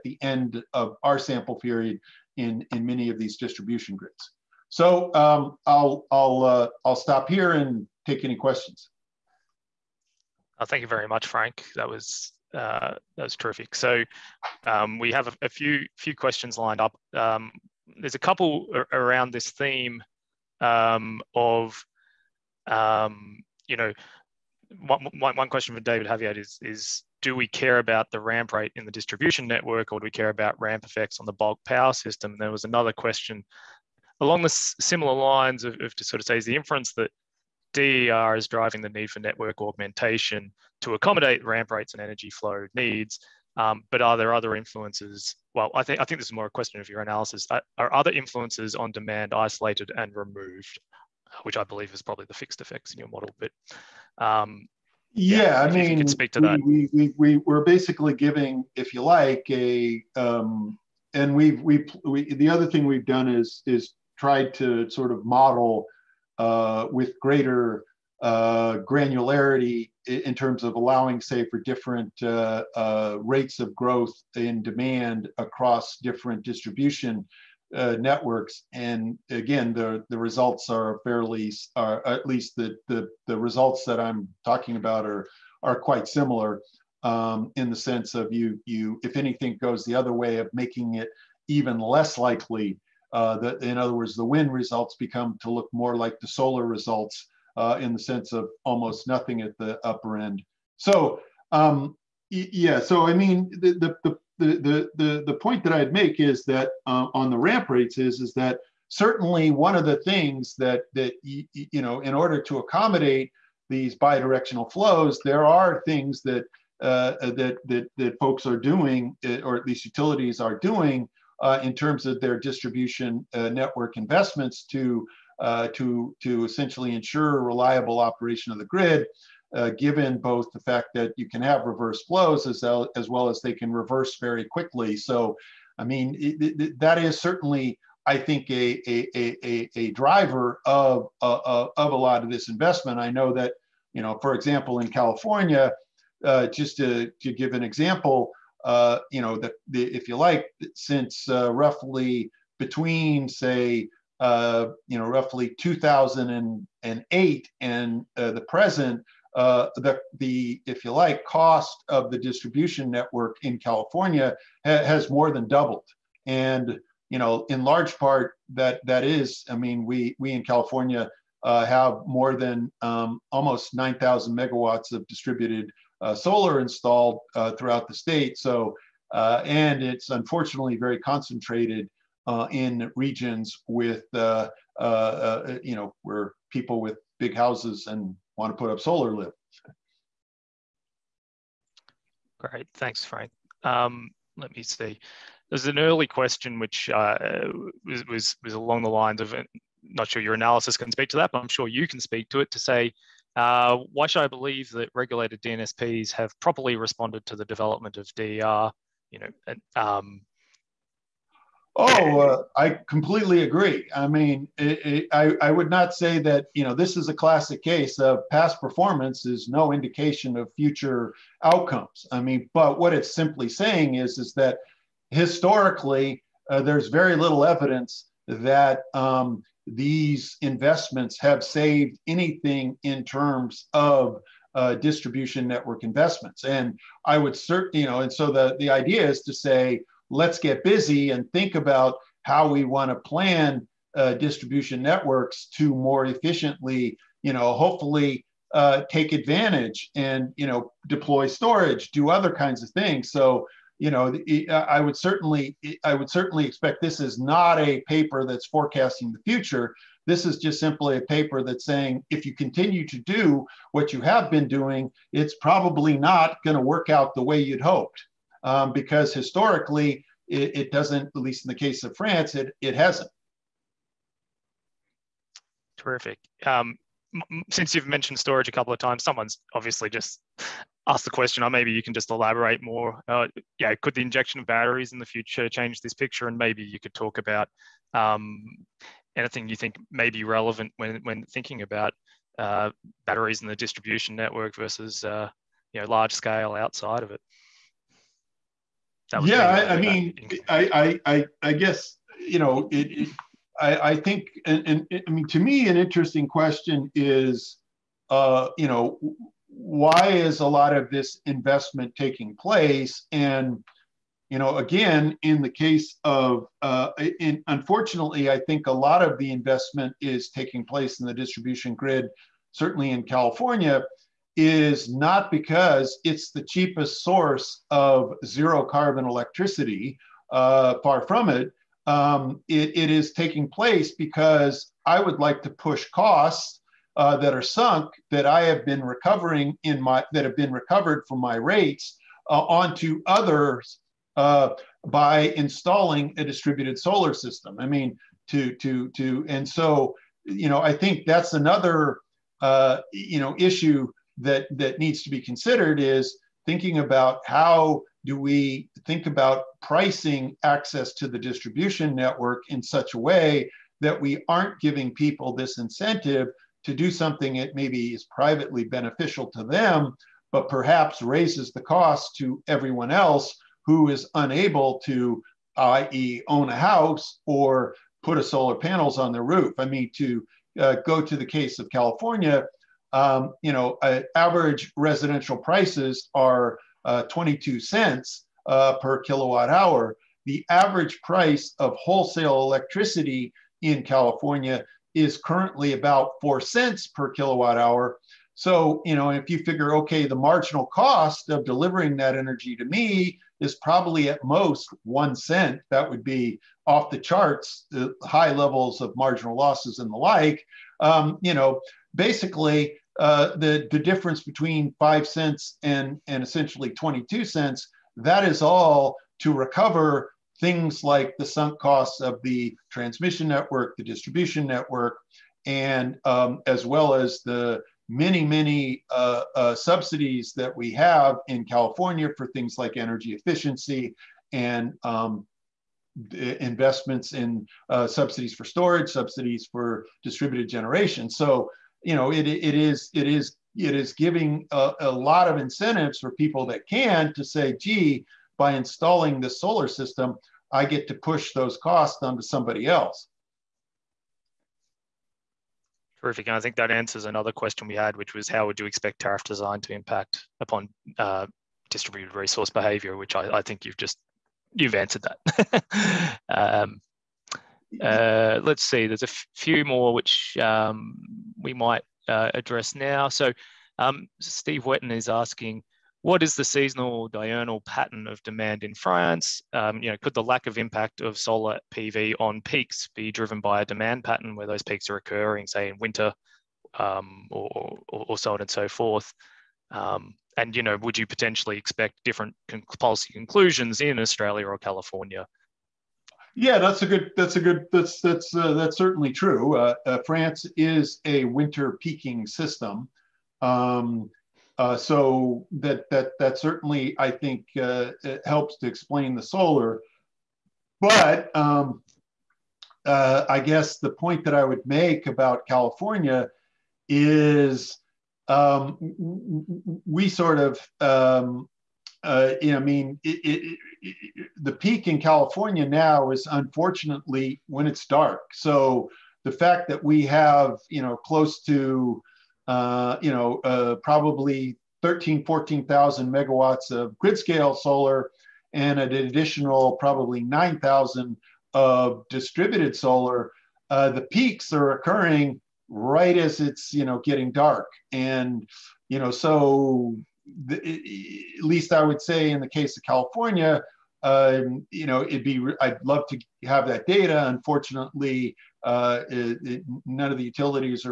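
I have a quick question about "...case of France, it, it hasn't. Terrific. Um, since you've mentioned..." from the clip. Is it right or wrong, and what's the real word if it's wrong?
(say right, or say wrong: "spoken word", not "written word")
right.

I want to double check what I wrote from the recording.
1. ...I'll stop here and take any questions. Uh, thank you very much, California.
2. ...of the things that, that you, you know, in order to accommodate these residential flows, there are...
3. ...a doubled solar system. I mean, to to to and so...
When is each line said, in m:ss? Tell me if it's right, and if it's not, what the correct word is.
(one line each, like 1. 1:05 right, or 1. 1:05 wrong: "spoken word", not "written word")
1. 0:06 wrong: "Frank", not "California"
2. 1:49 wrong: "bidirectional", not "residential"
3. 5:46 wrong: "distributed", not "doubled".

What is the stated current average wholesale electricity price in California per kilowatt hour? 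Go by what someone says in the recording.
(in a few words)
4 cents.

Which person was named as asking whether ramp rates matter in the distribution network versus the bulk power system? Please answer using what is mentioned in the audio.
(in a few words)
David Haviat.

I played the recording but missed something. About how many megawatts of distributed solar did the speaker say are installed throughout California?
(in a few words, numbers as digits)
9,000.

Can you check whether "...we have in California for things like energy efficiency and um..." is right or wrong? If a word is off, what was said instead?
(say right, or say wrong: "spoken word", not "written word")
right.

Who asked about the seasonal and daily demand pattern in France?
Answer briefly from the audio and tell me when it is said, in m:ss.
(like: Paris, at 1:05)
Steve Wetton, at 7:54.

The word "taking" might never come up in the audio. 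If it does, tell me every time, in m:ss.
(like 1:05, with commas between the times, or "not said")
5:11, 5:20, 5:33.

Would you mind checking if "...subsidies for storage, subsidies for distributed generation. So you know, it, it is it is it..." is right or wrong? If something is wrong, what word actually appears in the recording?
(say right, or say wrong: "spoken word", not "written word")
right.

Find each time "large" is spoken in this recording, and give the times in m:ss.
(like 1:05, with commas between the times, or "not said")
2:47, 4:55.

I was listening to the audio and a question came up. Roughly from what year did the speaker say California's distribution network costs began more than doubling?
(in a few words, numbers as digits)
2008.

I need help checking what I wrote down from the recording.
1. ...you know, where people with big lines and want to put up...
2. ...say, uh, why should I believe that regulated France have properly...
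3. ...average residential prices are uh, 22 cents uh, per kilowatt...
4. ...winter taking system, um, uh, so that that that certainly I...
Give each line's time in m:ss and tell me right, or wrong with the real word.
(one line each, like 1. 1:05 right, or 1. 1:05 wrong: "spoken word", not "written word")
1. 3:04 wrong: "houses", not "lines"
2. 3:22 wrong: "DNSPs", not "France"
3. 6:24 right
4. 8:21 wrong: "peaking", not "taking".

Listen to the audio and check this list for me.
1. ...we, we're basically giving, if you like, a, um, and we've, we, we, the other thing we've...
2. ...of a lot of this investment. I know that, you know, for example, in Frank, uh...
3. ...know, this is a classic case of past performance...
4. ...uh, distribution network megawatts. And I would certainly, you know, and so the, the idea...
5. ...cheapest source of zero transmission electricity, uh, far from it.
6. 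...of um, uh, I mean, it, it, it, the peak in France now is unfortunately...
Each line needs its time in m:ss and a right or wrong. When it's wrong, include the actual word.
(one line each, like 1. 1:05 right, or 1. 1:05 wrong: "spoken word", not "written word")
1. 0:57 right
2. 2:21 wrong: "California", not "Frank"
3. 3:36 right
4. 3:54 wrong: "investments", not "megawatts"
5. 5:26 wrong: "carbon", not "transmission"
6. 8:40 wrong: "California", not "France".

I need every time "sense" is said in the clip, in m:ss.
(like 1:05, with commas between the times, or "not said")
1:27, 1:37.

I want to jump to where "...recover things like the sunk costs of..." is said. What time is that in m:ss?
6:59.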